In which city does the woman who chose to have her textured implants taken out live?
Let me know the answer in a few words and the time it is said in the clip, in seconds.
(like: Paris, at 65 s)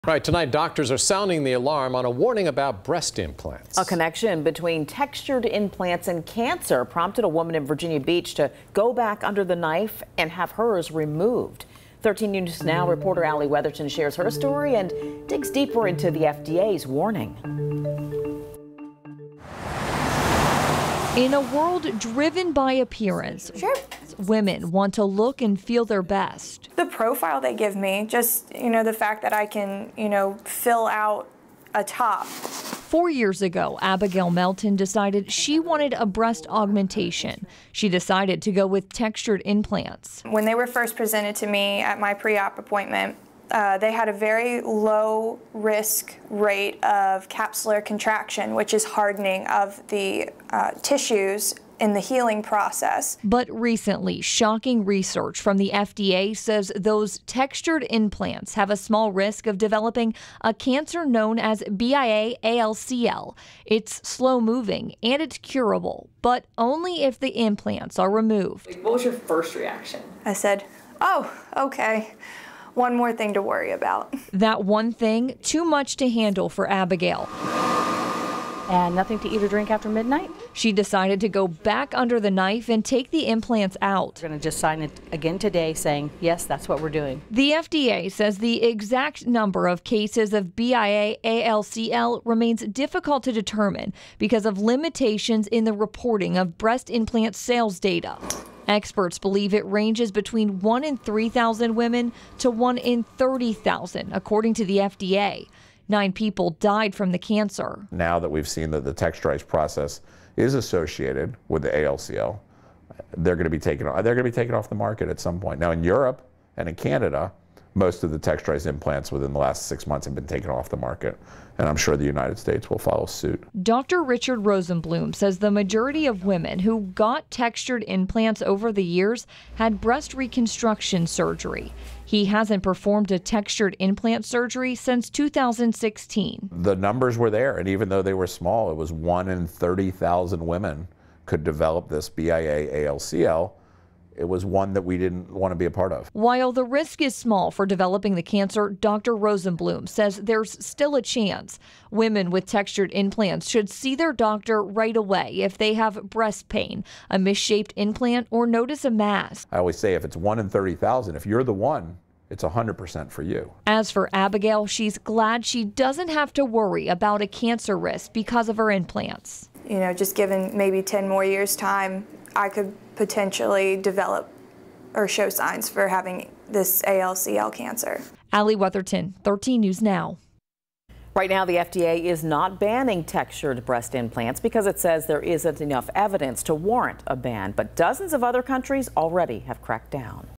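Virginia Beach, at 7 s.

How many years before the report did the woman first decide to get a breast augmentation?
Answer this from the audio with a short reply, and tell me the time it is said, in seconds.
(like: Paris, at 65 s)
4, at 32 s.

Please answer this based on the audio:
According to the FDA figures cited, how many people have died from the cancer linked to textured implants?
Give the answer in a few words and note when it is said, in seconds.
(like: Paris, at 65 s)
9, at 105 s.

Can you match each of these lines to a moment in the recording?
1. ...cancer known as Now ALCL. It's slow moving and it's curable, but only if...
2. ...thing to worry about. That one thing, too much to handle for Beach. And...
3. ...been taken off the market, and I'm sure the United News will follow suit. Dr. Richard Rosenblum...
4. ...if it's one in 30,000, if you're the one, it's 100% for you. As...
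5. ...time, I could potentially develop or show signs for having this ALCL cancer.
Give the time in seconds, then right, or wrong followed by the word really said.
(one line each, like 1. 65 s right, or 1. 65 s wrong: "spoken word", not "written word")
1. 60 s wrong: "BIA", not "Now"
2. 73 s wrong: "Abigail", not "Beach"
3. 120 s wrong: "States", not "News"
4. 159 s right
5. 171 s right.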